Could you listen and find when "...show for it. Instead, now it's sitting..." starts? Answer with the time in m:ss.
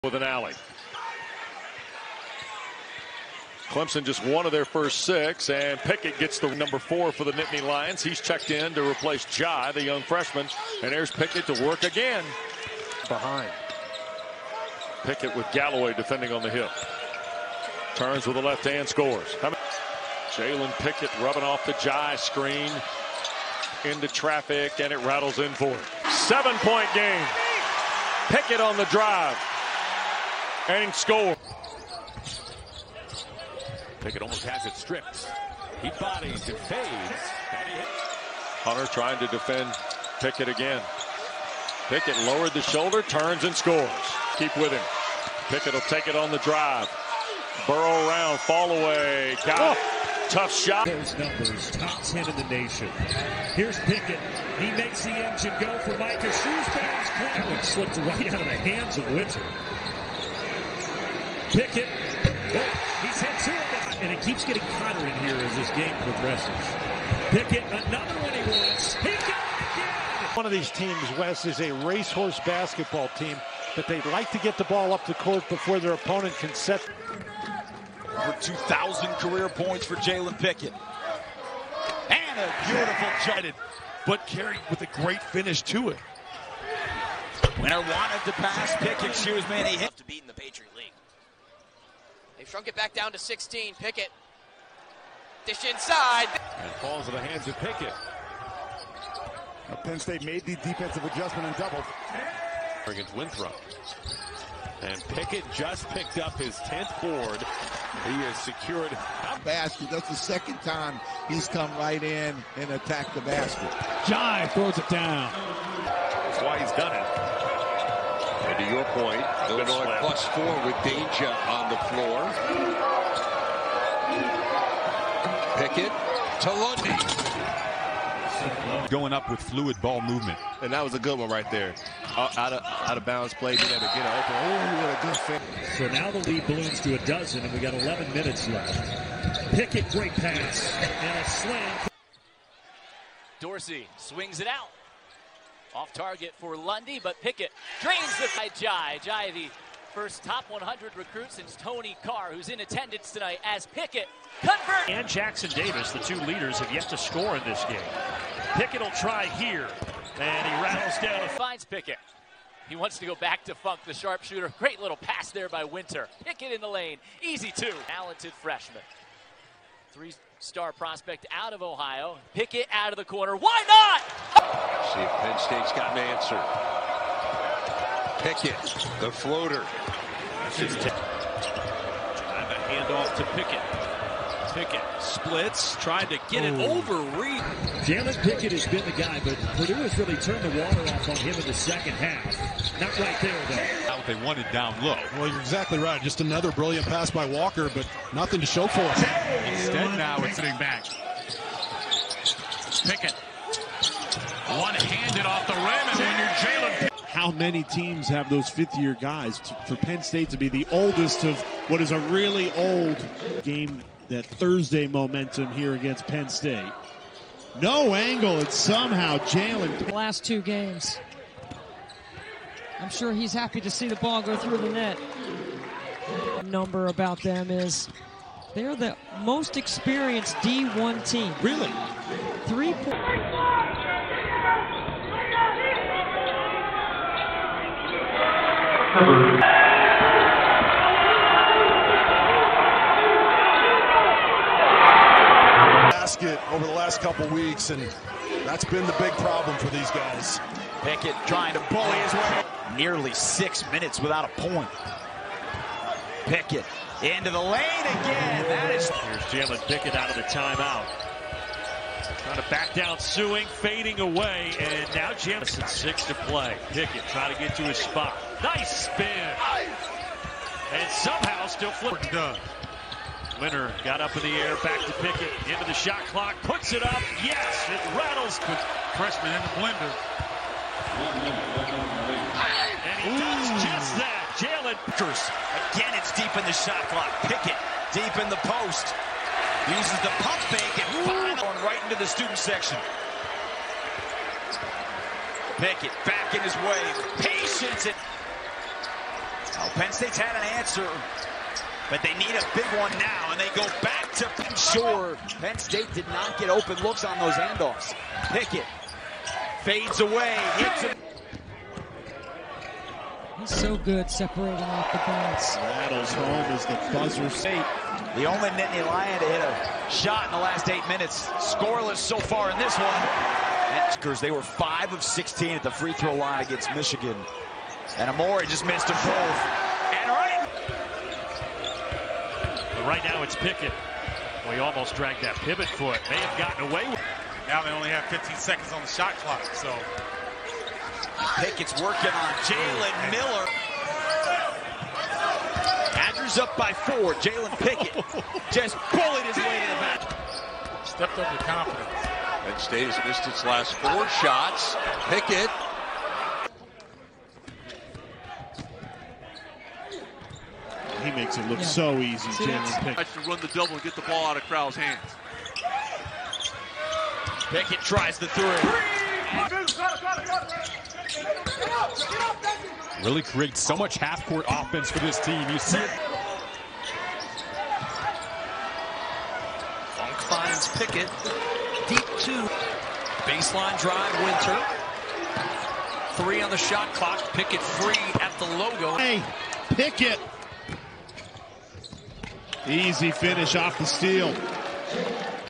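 3:18.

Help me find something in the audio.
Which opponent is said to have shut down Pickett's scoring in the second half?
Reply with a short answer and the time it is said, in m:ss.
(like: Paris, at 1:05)
Purdue, at 3:09.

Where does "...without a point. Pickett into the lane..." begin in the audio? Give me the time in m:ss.
4:13.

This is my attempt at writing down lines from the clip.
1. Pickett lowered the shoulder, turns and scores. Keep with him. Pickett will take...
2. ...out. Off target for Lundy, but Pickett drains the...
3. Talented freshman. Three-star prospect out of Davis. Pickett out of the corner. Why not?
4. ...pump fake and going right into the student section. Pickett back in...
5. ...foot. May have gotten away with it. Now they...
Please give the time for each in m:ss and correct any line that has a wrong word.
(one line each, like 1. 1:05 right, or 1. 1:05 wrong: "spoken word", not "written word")
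1. 0:41 right
2. 2:24 right
3. 2:47 wrong: "Ohio", not "Davis"
4. 4:50 right
5. 5:35 right.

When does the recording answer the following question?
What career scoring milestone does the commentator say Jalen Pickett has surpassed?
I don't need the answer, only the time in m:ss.
1:18.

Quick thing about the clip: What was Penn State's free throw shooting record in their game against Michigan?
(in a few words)
5 of 16.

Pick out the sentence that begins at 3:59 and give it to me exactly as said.
Basket over the last couple weeks, and that's been the big problem for these guys.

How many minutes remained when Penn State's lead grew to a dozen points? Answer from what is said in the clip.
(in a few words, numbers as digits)
11.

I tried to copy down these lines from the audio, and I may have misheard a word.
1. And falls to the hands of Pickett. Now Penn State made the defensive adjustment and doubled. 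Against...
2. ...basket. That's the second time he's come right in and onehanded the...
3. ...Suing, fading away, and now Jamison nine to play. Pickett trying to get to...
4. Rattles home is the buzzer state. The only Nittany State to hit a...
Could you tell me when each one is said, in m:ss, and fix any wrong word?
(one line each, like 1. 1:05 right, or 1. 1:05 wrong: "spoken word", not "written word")
1. 1:36 right
2. 1:49 wrong: "attacked", not "onehanded"
3. 4:22 wrong: "six", not "nine"
4. 5:15 wrong: "Lion", not "State".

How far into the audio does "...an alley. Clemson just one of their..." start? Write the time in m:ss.
0:00.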